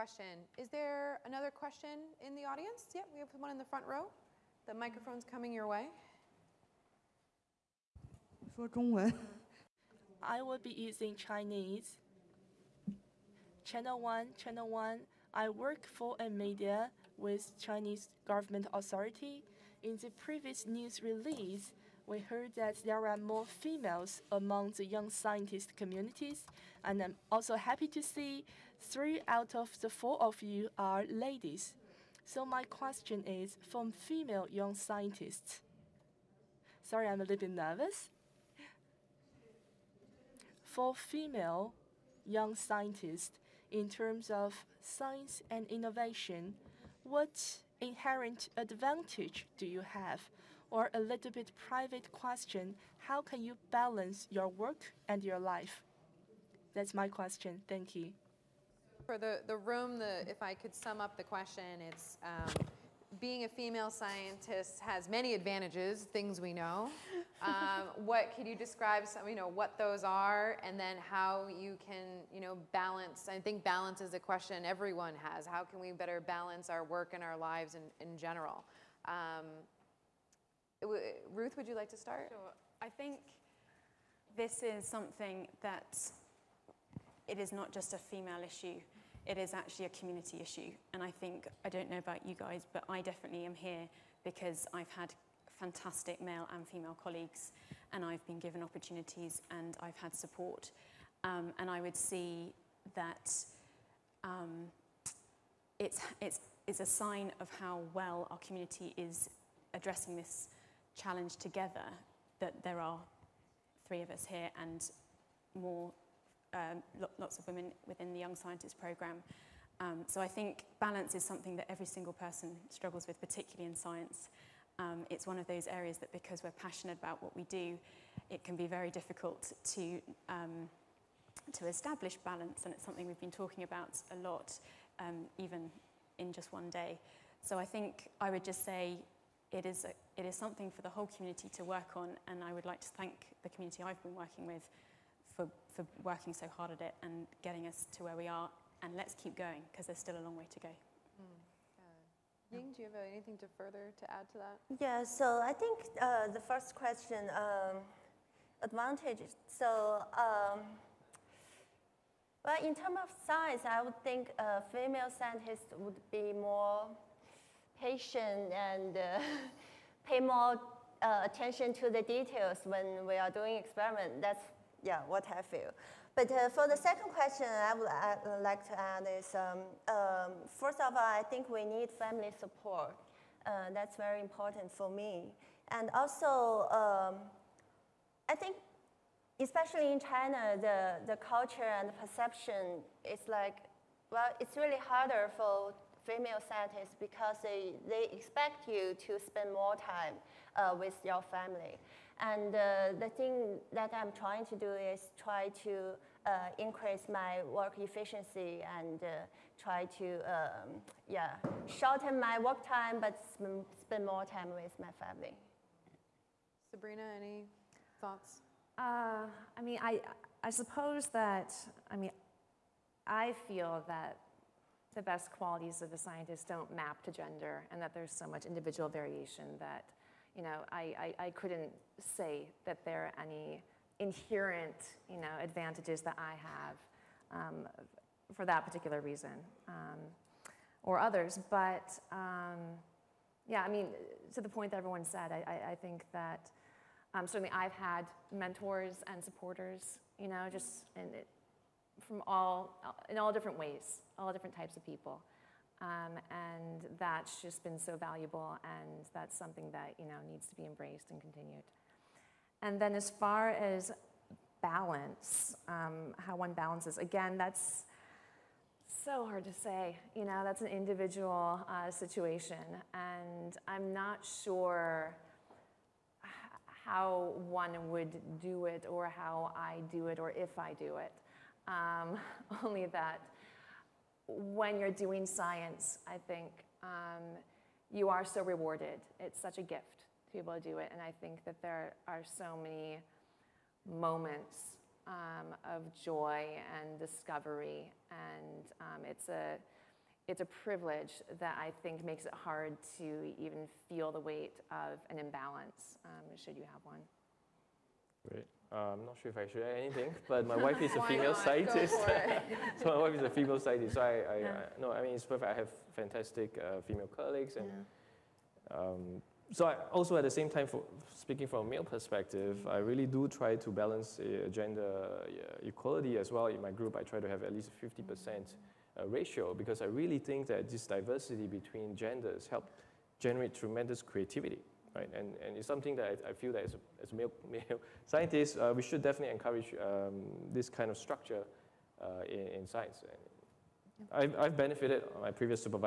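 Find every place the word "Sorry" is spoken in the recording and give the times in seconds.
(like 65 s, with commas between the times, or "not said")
36 s.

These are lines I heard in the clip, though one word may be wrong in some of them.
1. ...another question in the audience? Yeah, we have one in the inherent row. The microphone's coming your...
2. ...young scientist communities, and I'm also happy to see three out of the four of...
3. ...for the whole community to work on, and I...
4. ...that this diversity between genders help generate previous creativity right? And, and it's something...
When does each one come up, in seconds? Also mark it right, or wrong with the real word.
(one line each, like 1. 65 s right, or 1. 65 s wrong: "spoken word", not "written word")
1. 1 s wrong: "front", not "inherent"
2. 24 s right
3. 140 s right
4. 330 s wrong: "tremendous", not "previous".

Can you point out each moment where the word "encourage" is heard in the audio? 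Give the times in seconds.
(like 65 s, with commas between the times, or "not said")
339 s.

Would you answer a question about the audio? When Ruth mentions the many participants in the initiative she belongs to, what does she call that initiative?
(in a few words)
Young Scientists programme.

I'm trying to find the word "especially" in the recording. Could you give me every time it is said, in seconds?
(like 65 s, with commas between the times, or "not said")
189 s.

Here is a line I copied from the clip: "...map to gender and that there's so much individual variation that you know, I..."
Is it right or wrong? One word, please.
right.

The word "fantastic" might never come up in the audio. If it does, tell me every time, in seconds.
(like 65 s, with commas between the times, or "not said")
95 s, 315 s.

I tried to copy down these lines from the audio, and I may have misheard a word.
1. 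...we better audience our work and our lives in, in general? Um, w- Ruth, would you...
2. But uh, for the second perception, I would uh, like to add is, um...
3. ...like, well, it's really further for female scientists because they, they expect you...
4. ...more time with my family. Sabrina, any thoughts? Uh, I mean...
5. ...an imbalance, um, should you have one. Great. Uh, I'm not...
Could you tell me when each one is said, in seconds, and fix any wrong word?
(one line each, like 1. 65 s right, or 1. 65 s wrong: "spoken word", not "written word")
1. 75 s wrong: "balance", not "audience"
2. 176 s wrong: "question", not "perception"
3. 193 s wrong: "harder", not "further"
4. 214 s right
5. 305 s right.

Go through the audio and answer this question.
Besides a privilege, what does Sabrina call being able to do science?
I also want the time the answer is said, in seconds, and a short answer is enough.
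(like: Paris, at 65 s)
A gift, at 289 s.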